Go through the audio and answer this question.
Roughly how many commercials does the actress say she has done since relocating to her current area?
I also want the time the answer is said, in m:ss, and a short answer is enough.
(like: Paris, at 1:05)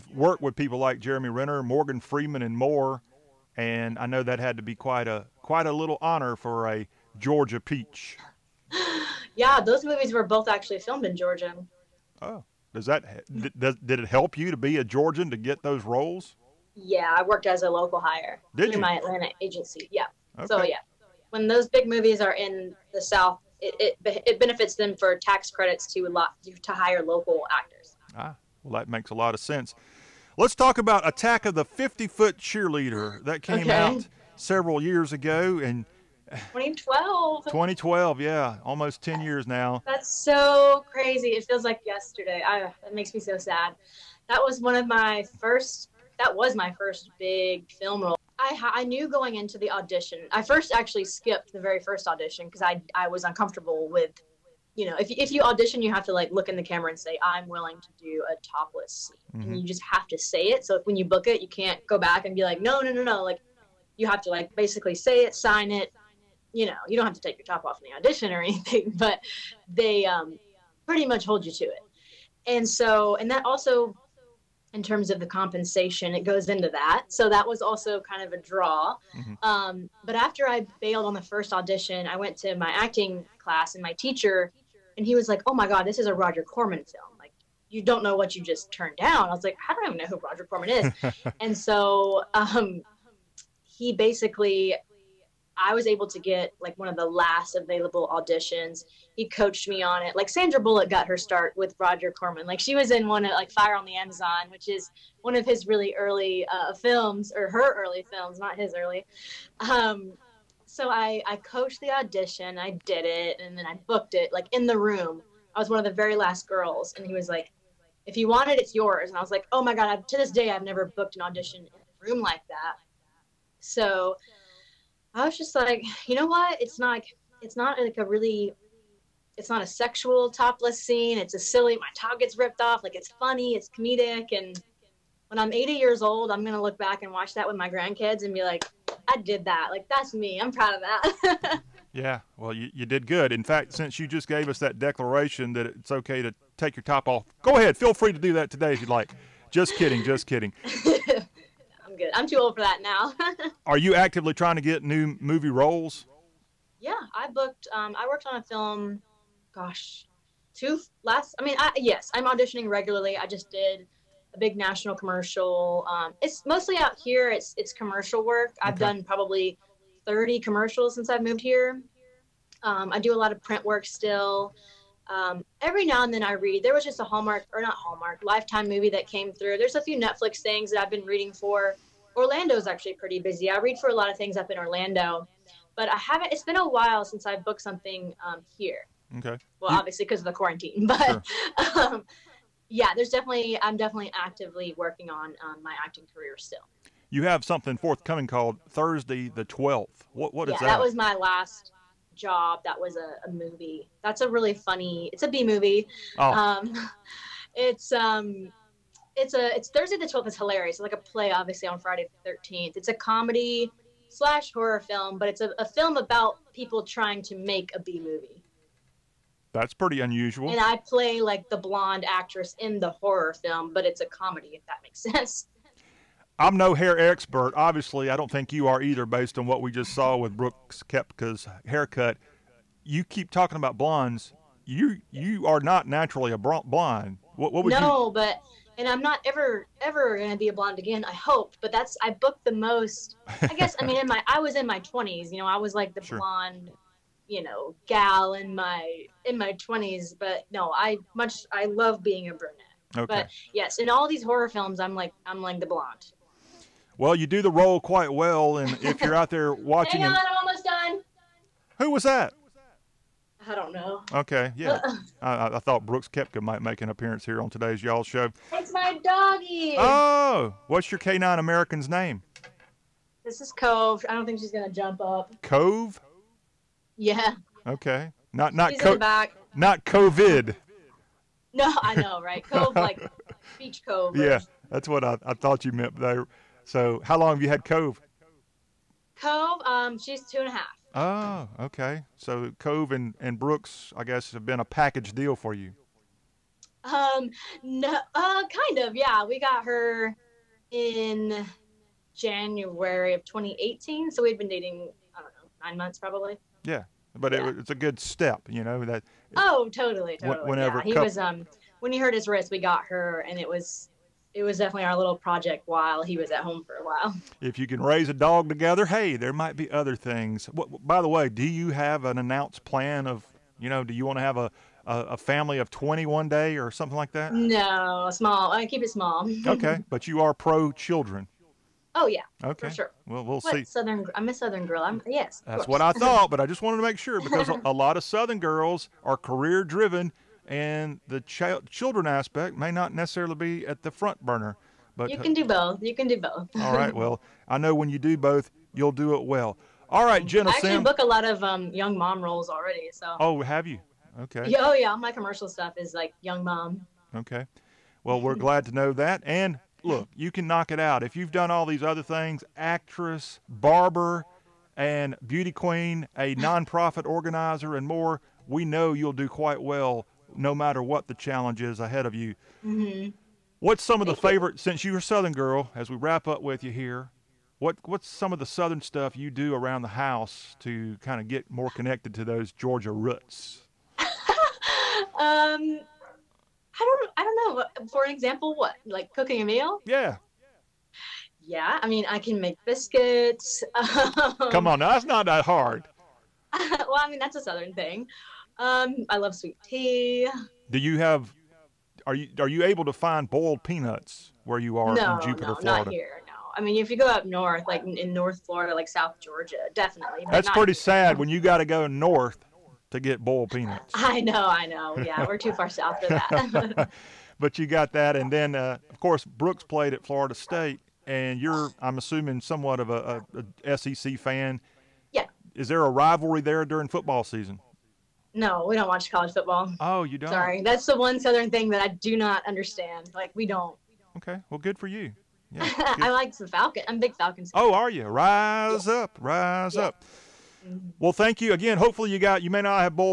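30, at 2:50.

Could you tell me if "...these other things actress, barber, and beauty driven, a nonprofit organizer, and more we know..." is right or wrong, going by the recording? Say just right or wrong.
wrong.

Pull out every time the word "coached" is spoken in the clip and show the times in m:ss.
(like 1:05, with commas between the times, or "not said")
1:39, 1:51.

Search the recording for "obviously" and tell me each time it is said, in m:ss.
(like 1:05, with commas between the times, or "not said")
3:09, 3:31, 3:47.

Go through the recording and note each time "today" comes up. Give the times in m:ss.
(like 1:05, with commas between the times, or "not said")
2:28, 4:27.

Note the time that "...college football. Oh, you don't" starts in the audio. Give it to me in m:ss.
7:09.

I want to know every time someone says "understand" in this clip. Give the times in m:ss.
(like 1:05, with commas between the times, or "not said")
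7:12.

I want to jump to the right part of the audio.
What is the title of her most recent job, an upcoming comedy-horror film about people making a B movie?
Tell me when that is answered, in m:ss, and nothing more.
3:18.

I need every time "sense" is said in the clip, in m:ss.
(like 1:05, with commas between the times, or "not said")
0:29, 3:44.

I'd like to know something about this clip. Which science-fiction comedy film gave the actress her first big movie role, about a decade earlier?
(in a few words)
Attack of the 50 Foot Cheerleader.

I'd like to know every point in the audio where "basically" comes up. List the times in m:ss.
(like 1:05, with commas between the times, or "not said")
1:04, 1:33.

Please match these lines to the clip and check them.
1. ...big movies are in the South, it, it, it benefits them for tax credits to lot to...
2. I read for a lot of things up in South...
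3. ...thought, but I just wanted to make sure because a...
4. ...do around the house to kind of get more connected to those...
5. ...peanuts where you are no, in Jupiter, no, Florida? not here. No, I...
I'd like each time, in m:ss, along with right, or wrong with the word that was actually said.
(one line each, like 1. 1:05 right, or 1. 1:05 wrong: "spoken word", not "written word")
1. 0:21 right
2. 3:03 wrong: "Orlando", not "South"
3. 5:35 right
4. 6:19 right
5. 6:43 right.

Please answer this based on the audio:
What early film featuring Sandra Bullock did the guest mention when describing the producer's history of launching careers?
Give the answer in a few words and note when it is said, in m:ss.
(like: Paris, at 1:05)
Fire on the Amazon, at 1:43.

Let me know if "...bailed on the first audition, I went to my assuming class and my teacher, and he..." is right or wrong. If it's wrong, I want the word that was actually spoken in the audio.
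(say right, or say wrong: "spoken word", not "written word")
wrong: "acting", not "assuming".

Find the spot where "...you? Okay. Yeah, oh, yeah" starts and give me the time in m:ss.
5:53.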